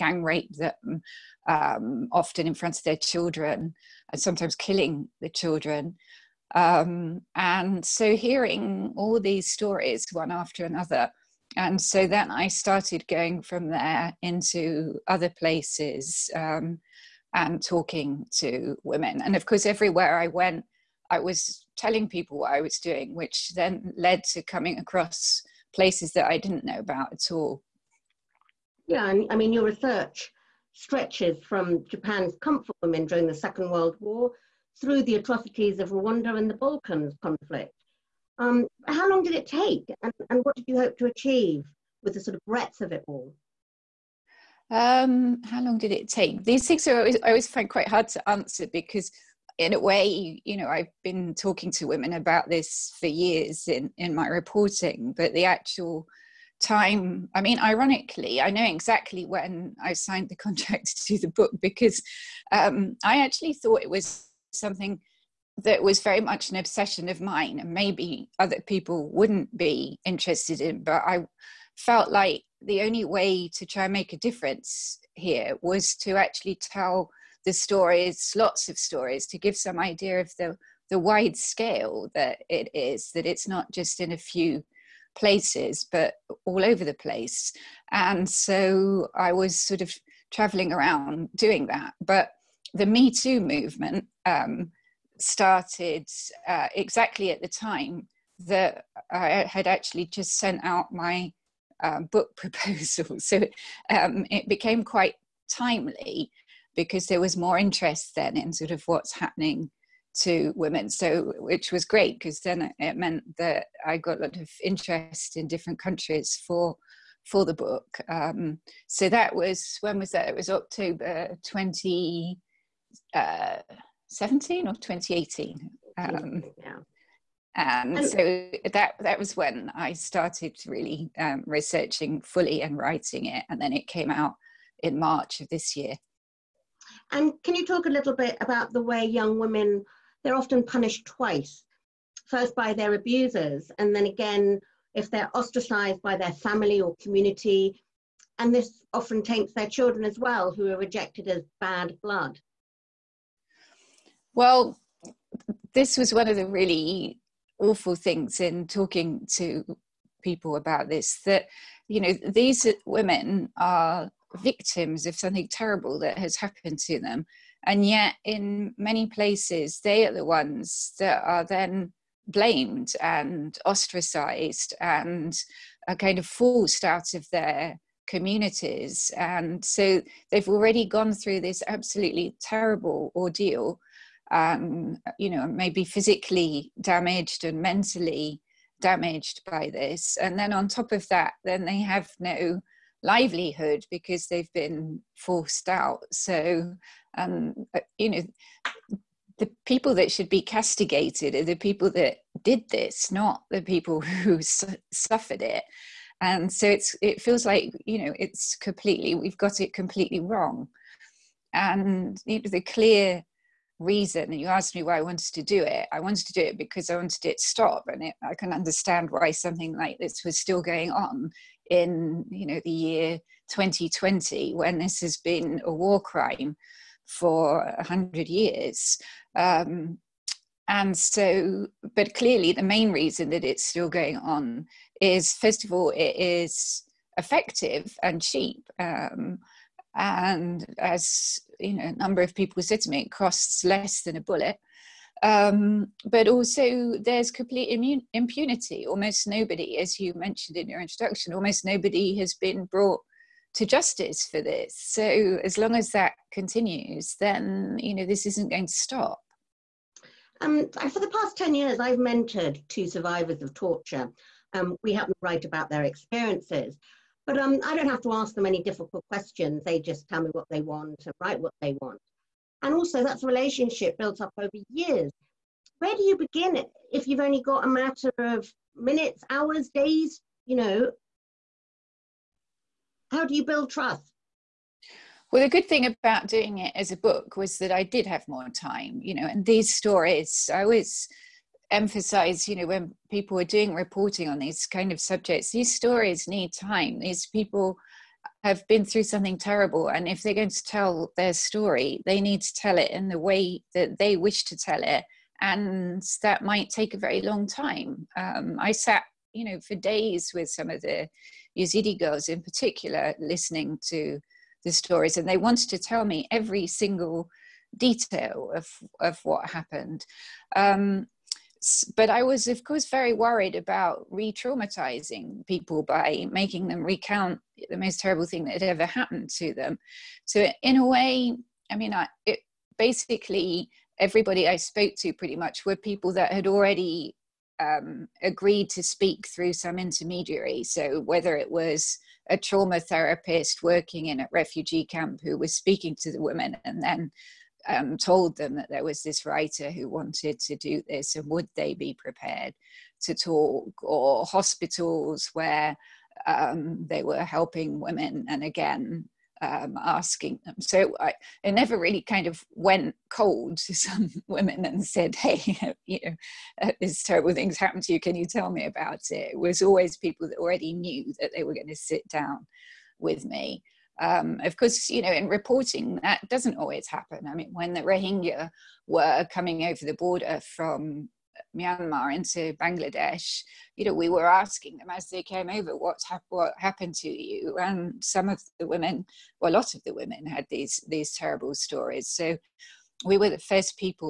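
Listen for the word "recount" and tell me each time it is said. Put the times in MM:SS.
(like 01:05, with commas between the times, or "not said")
05:26.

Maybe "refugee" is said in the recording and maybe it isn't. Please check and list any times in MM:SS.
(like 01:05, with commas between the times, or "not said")
05:44.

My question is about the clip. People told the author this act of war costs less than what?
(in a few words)
a bullet.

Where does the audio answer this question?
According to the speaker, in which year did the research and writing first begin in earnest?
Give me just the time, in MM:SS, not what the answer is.
02:01.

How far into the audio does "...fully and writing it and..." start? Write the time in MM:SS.
02:12.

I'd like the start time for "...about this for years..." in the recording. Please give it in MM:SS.
00:52.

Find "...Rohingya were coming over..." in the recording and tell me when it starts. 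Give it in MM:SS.
06:17.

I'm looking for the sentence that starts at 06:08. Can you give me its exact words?
Can you tell me about it?" It was always people that already knew that they were going to sit down with me.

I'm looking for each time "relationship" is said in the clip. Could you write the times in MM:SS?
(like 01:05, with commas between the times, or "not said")
04:33.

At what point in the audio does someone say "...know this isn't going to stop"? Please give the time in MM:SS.
04:17.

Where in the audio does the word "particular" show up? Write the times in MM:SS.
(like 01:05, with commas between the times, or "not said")
05:12.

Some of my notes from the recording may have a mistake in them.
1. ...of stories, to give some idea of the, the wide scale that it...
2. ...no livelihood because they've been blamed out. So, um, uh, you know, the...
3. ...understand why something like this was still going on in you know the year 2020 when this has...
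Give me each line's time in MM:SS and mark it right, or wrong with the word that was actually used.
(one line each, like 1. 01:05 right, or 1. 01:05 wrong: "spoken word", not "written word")
1. 01:18 right
2. 03:12 wrong: "forced", not "blamed"
3. 03:38 right.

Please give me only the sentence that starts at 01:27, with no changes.
And so I was sort of traveling around doing that.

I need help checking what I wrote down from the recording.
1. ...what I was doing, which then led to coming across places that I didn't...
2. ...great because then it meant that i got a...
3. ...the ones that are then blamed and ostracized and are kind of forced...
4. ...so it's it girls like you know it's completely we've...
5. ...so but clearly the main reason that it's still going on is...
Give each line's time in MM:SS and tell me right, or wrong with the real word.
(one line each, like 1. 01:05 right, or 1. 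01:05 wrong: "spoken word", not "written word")
1. 00:22 right
2. 01:51 right
3. 02:50 right
4. 03:26 wrong: "feels", not "girls"
5. 03:50 right.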